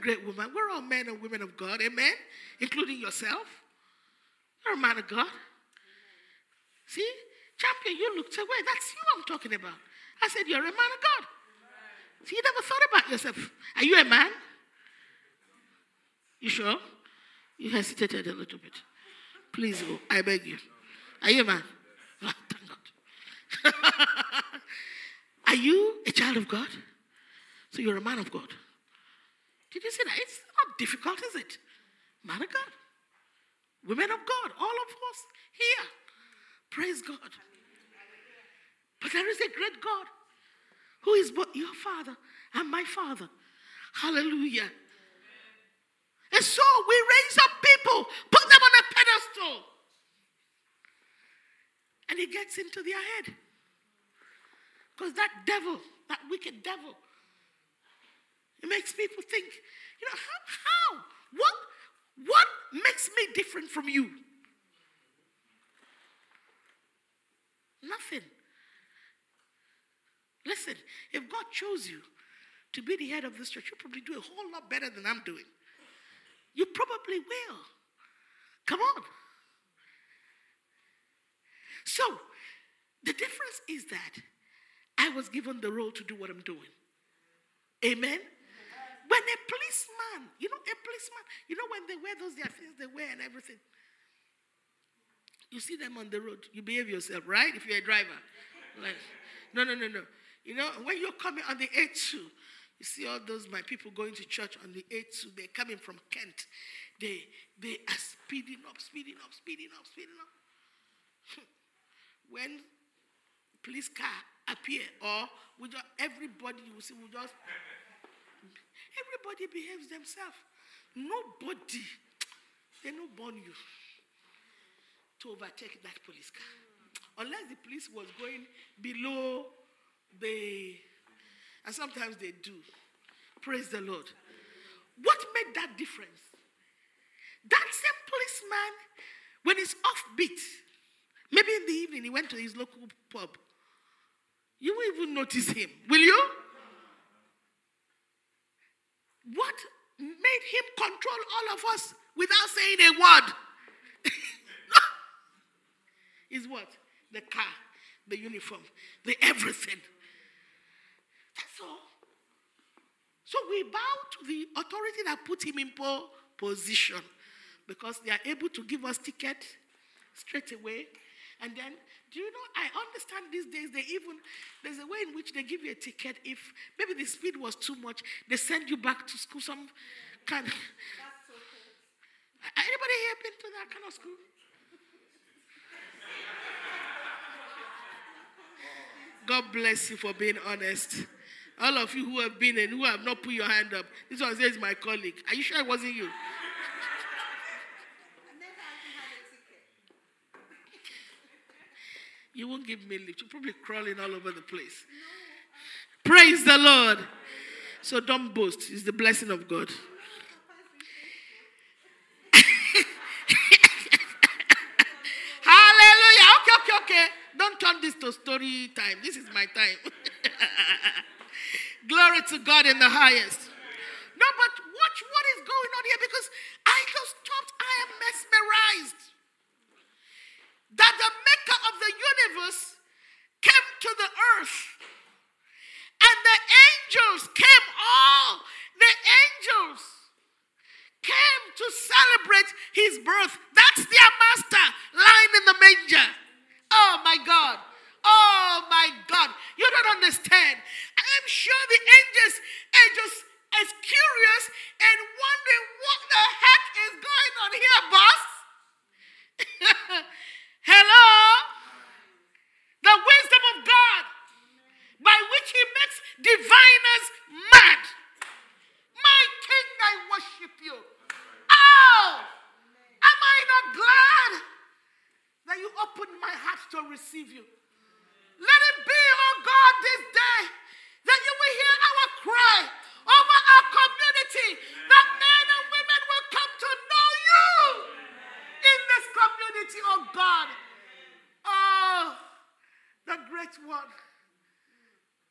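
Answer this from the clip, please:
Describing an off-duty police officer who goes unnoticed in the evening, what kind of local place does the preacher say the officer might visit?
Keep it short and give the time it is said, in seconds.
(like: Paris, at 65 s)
pub, at 143 s.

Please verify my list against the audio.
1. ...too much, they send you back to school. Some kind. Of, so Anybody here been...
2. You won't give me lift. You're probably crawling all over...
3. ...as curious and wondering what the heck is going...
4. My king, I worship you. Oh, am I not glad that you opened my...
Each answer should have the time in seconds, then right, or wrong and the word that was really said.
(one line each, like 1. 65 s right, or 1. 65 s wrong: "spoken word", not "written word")
1. 177 s right
2. 202 s right
3. 253 s right
4. 268 s right.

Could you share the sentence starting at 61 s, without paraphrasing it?
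What, what makes me different from you?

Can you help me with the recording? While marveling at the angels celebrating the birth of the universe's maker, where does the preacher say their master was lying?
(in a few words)
in the manger.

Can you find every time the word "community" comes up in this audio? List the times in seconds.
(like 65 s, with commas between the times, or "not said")
283 s, 289 s.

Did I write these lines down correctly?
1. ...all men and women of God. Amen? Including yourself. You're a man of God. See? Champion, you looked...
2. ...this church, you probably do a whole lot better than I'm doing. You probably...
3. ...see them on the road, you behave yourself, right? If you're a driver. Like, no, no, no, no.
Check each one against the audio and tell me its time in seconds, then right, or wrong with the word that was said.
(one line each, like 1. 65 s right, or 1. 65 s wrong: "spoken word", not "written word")
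1. 0 s right
2. 73 s right
3. 95 s right.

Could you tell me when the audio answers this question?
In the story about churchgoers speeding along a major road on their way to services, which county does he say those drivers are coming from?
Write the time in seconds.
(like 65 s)
106 s.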